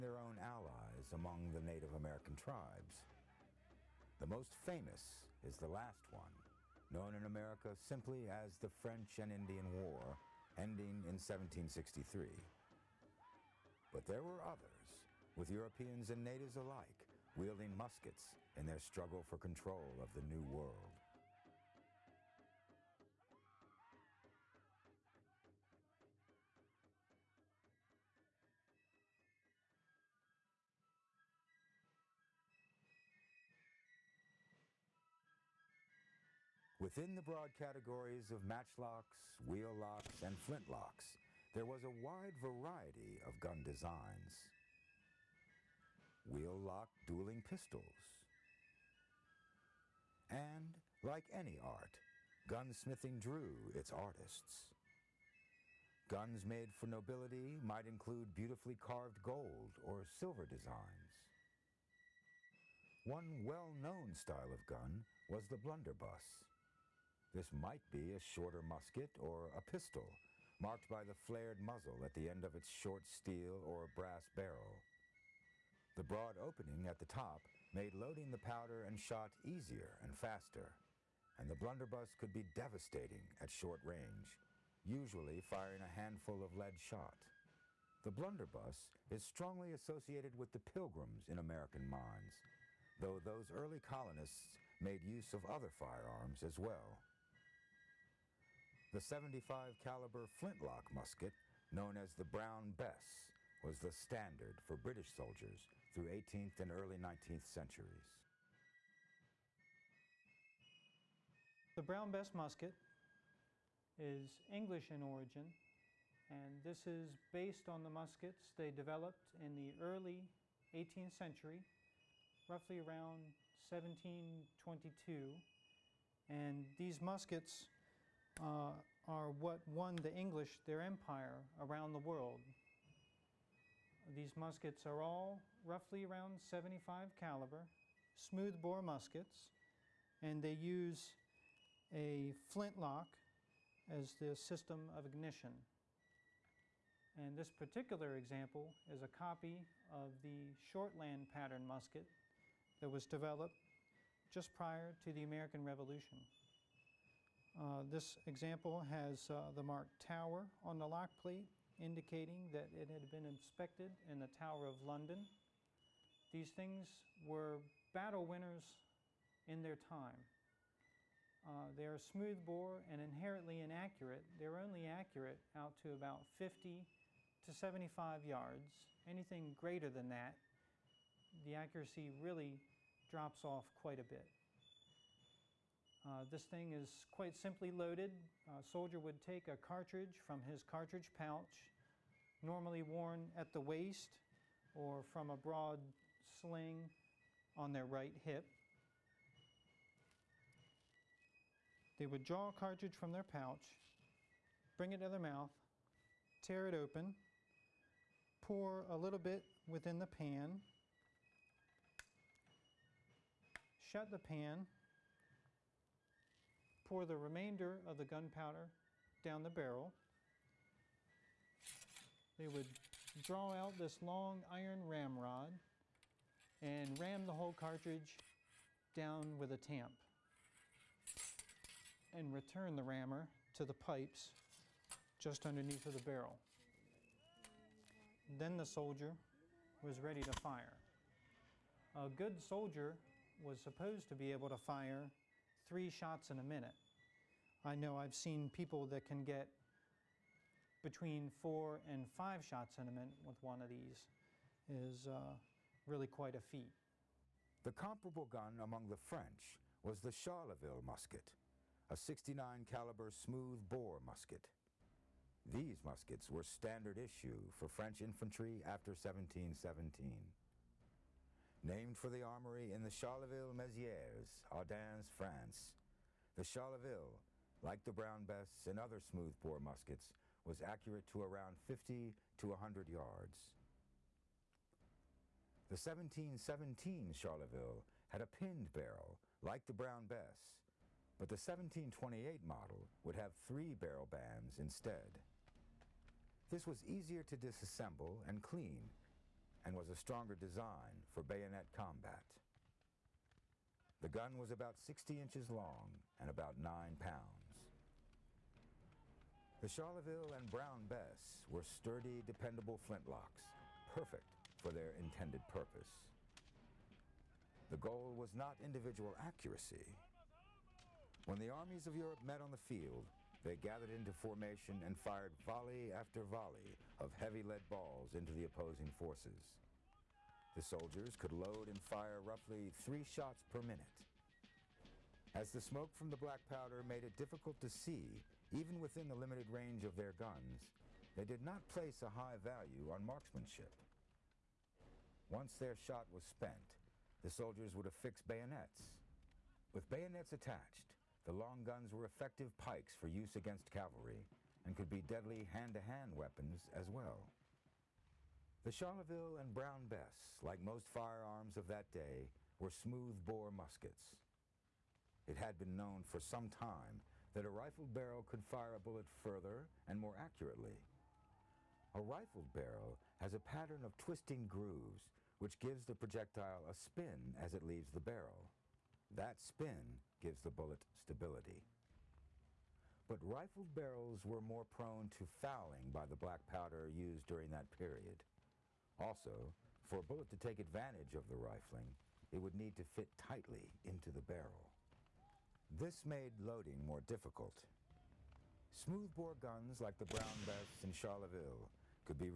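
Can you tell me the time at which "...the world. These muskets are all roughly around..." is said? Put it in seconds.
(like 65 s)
131 s.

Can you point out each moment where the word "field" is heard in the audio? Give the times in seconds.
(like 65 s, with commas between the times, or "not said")
322 s.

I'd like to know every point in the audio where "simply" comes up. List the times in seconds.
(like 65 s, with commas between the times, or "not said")
7 s, 187 s.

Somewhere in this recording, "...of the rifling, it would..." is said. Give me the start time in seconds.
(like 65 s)
391 s.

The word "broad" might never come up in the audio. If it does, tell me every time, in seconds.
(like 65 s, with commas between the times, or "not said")
37 s, 76 s, 195 s.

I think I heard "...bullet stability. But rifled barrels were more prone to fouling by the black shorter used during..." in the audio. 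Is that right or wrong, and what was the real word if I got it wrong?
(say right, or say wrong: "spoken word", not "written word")
wrong: "powder", not "shorter".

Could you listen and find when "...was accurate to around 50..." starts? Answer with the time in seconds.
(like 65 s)
280 s.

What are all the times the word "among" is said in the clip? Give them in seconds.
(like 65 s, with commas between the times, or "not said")
1 s, 258 s.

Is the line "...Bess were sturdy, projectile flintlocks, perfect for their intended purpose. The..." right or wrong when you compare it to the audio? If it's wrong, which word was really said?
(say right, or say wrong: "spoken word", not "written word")
wrong: "dependable", not "projectile".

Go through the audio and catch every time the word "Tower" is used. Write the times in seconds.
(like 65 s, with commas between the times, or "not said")
159 s, 164 s.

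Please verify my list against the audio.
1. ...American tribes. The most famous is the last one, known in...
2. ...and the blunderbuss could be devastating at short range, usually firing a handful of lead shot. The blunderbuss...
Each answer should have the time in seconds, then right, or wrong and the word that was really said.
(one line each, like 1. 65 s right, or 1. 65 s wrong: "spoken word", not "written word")
1. 1 s right
2. 81 s right.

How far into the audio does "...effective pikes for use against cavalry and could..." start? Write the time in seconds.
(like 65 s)
352 s.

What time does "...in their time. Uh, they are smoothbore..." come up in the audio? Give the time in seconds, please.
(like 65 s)
169 s.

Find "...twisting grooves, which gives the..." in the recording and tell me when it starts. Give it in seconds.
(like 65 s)
373 s.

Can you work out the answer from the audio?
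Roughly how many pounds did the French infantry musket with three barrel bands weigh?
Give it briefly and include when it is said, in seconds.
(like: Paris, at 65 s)
9, at 306 s.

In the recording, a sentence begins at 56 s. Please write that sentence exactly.
Guns made for nobility might include beautifully carved gold or silver designs.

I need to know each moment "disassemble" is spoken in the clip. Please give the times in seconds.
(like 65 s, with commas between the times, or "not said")
297 s.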